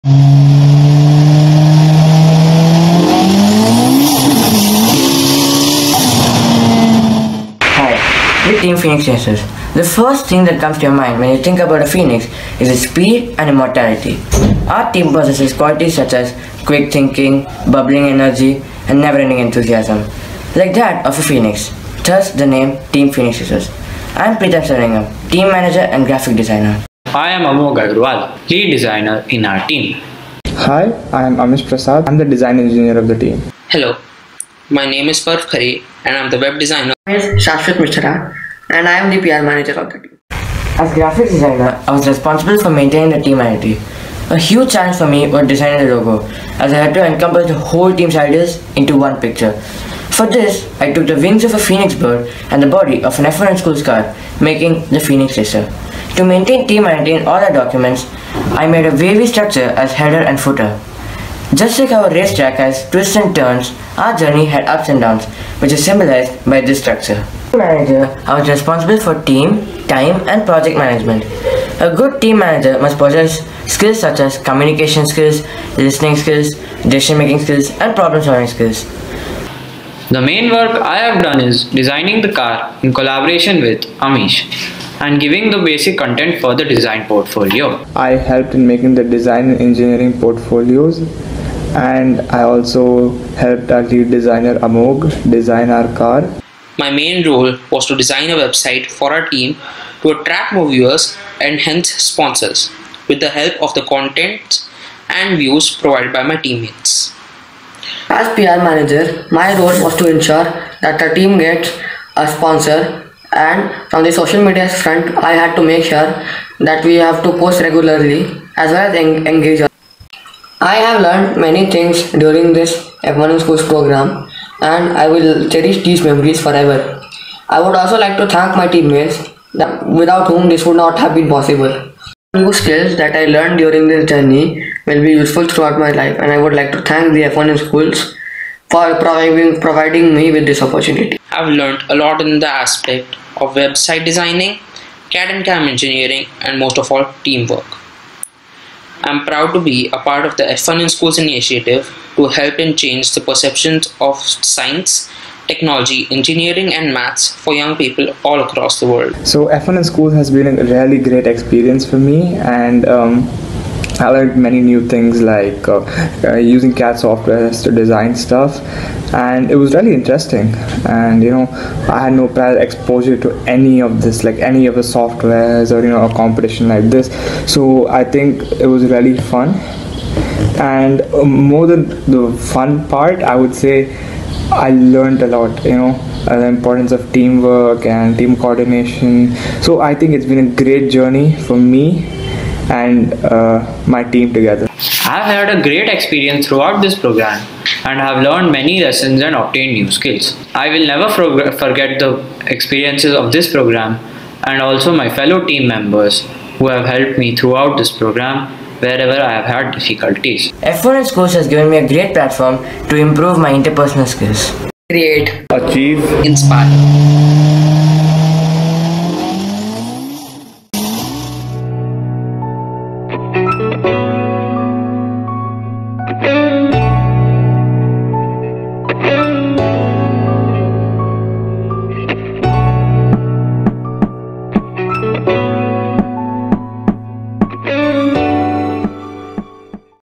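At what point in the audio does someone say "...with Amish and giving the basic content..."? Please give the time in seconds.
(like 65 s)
83 s.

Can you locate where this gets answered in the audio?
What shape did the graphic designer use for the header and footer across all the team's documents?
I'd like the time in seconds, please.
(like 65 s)
58 s.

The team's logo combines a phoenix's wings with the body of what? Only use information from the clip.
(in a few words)
an F1 school car.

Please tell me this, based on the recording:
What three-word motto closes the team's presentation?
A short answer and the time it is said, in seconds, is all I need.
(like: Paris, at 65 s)
Create, achieve, inspire, at 214 s.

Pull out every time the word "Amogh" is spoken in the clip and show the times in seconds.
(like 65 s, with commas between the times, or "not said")
27 s, 94 s.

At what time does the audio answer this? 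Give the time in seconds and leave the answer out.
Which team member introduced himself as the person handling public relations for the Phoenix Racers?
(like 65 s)
37 s.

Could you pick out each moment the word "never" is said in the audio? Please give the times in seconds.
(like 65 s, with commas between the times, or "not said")
18 s, 200 s.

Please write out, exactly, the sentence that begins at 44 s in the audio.
A huge challenge for me was designing the logo, as I had to encompass the whole team's ideas into one picture.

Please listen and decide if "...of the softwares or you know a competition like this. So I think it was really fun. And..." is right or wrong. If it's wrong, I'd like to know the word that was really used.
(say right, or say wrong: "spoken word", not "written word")
right.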